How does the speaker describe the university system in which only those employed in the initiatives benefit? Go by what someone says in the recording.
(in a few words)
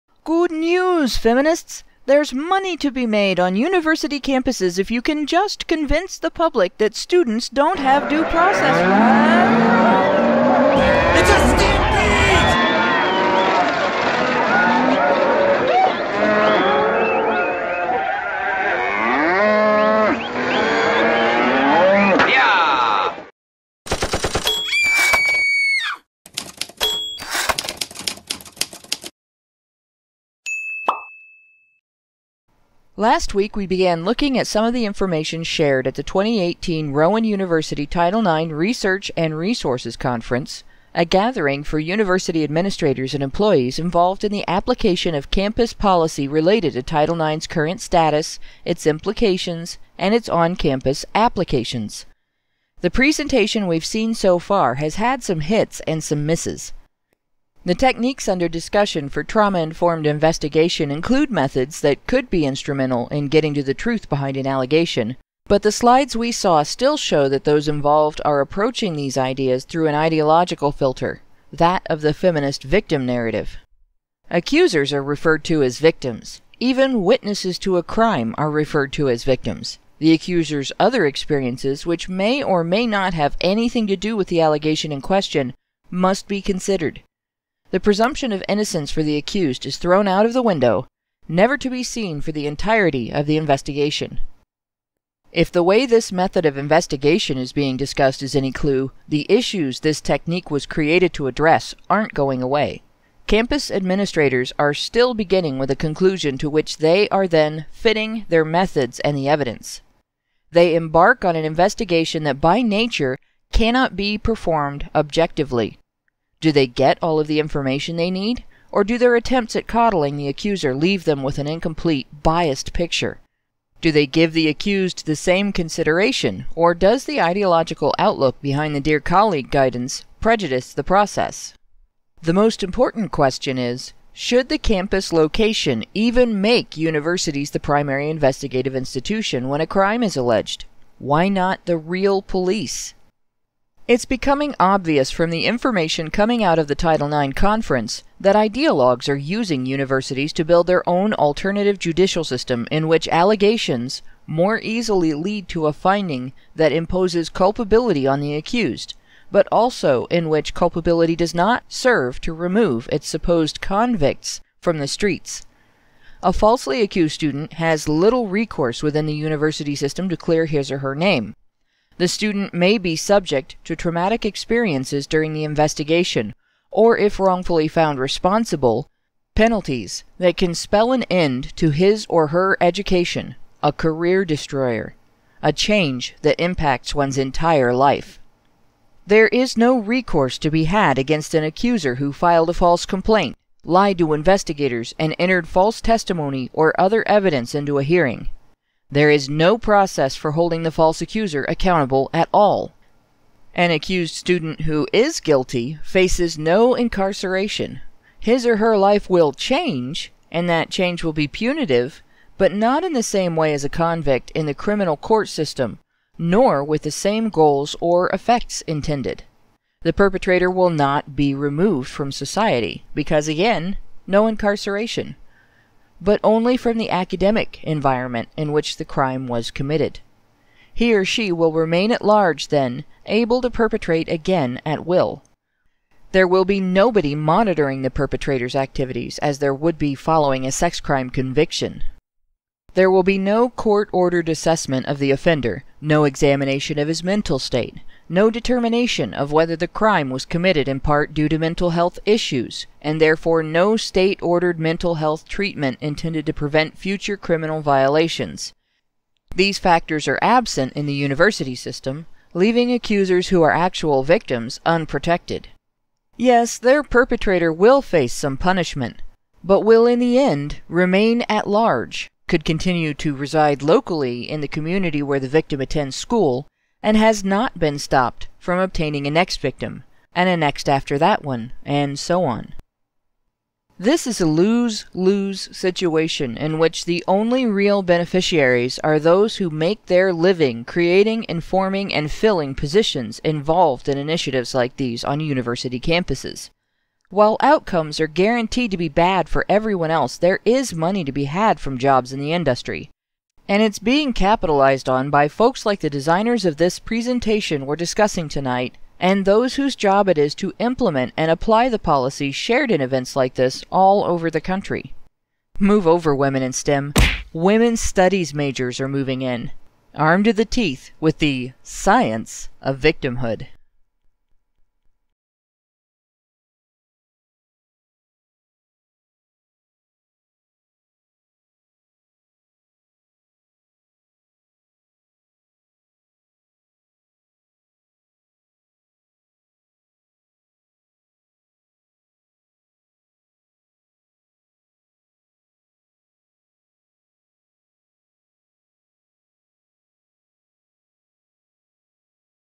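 lose lose.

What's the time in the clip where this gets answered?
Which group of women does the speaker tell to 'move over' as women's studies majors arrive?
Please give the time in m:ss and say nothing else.
5:16.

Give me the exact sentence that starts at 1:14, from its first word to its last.
Accusers are referred to as victims.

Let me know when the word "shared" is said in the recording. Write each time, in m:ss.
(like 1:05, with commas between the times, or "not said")
0:35, 5:12.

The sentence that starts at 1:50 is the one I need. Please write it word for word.
They embark on an investigation that by nature cannot be performed objectively.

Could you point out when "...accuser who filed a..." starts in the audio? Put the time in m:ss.
3:11.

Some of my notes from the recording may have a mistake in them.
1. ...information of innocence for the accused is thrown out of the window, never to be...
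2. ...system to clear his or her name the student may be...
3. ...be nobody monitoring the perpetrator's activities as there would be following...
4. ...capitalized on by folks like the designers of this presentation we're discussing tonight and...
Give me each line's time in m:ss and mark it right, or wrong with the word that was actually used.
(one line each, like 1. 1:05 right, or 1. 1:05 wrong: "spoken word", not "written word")
1. 1:27 wrong: "presumption", not "information"
2. 2:49 right
3. 3:56 right
4. 5:04 right.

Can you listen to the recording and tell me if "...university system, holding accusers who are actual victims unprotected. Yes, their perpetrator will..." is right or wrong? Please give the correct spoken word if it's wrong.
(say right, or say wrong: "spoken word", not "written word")
wrong: "leaving", not "holding".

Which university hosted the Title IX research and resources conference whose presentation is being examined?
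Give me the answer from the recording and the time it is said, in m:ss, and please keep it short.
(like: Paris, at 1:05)
Rowan University, at 0:36.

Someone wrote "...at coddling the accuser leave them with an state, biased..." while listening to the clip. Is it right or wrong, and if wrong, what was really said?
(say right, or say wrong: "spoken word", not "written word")
wrong: "incomplete", not "state".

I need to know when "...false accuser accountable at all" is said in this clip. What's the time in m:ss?
3:20.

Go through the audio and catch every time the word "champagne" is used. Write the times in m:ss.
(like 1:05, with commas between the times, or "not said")
not said.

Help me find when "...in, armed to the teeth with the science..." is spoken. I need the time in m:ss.
5:19.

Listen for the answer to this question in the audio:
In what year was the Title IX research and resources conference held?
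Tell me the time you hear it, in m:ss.
0:36.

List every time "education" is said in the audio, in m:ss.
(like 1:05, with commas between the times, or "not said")
3:02.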